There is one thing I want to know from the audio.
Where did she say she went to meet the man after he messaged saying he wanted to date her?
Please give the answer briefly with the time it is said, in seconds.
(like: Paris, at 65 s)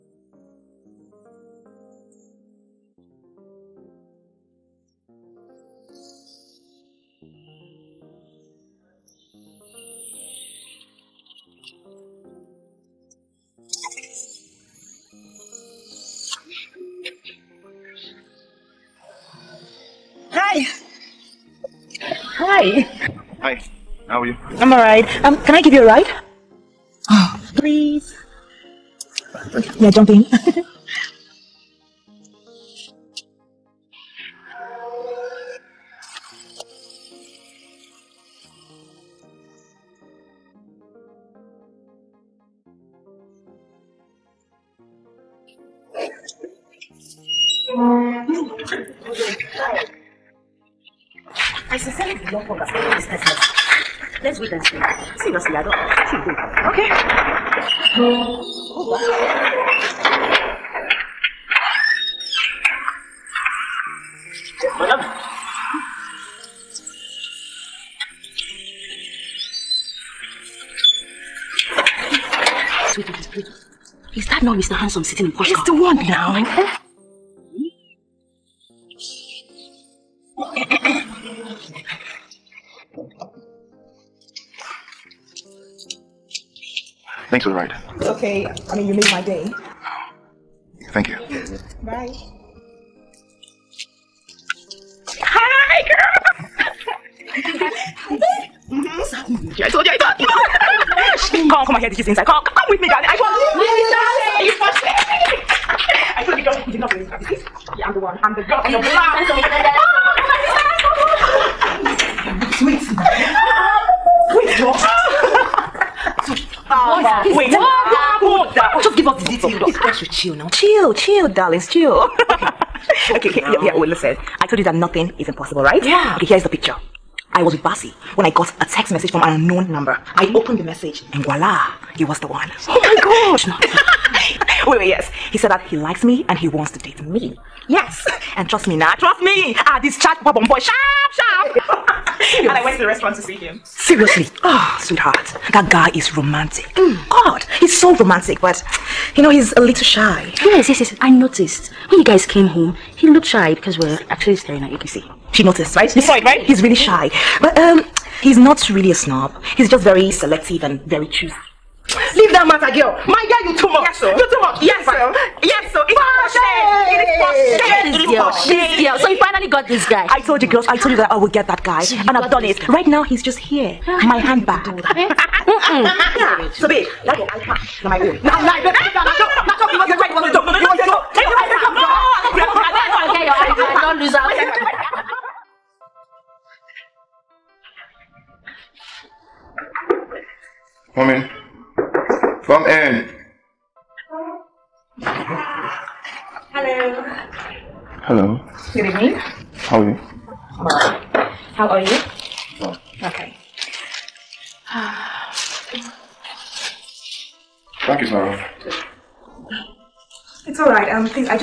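the restaurant, at 142 s.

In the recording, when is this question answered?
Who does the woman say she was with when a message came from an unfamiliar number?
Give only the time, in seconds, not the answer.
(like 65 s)
127 s.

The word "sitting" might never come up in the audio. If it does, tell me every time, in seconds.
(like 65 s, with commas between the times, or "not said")
75 s.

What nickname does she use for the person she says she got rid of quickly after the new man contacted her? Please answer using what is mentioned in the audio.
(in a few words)
Papa Bomboy.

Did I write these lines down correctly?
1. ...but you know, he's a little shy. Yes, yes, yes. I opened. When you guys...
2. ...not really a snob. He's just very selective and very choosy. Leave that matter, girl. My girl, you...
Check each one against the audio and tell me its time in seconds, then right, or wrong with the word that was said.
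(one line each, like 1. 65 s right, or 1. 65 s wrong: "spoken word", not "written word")
1. 148 s wrong: "noticed", not "opened"
2. 158 s right.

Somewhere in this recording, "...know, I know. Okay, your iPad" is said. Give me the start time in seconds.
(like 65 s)
182 s.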